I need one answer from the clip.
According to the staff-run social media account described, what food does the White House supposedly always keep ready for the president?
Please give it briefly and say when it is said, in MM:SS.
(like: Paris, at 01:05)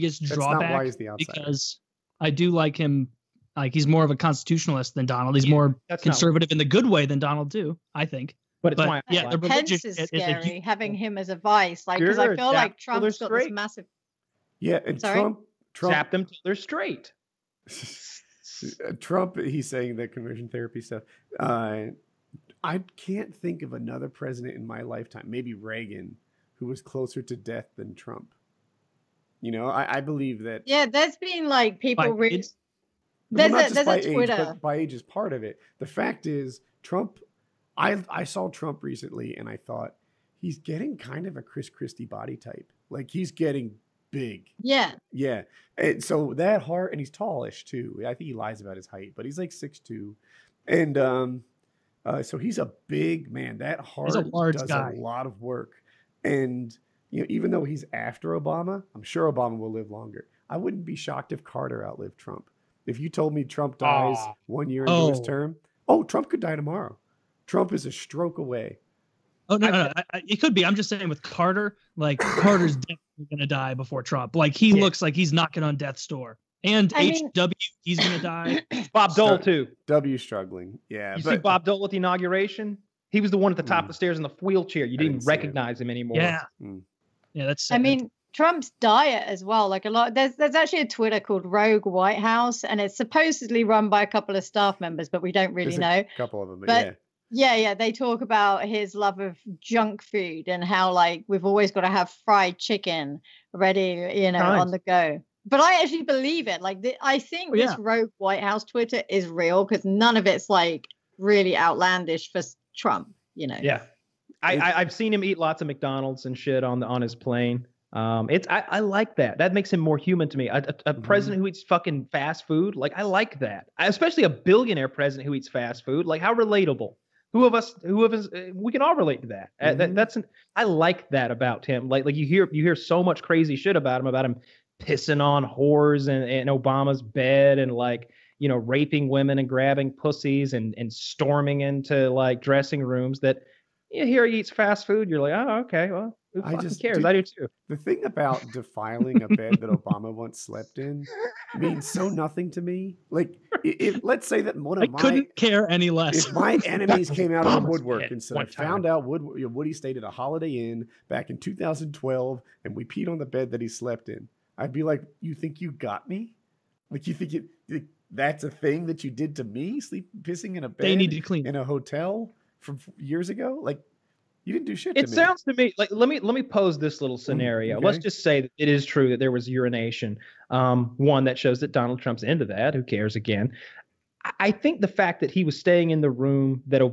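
Fried chicken, at 01:42.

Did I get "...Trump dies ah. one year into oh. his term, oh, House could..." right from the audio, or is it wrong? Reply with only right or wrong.
wrong.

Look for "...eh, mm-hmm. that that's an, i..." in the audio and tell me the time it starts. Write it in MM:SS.
02:09.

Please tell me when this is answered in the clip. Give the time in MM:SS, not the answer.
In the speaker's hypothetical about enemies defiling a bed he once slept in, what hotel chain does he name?
02:40.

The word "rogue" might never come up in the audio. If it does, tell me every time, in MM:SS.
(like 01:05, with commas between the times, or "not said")
01:31, 01:47.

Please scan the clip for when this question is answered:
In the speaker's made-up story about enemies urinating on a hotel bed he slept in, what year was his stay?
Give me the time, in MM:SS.
02:41.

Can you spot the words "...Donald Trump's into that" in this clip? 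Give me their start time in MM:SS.
03:01.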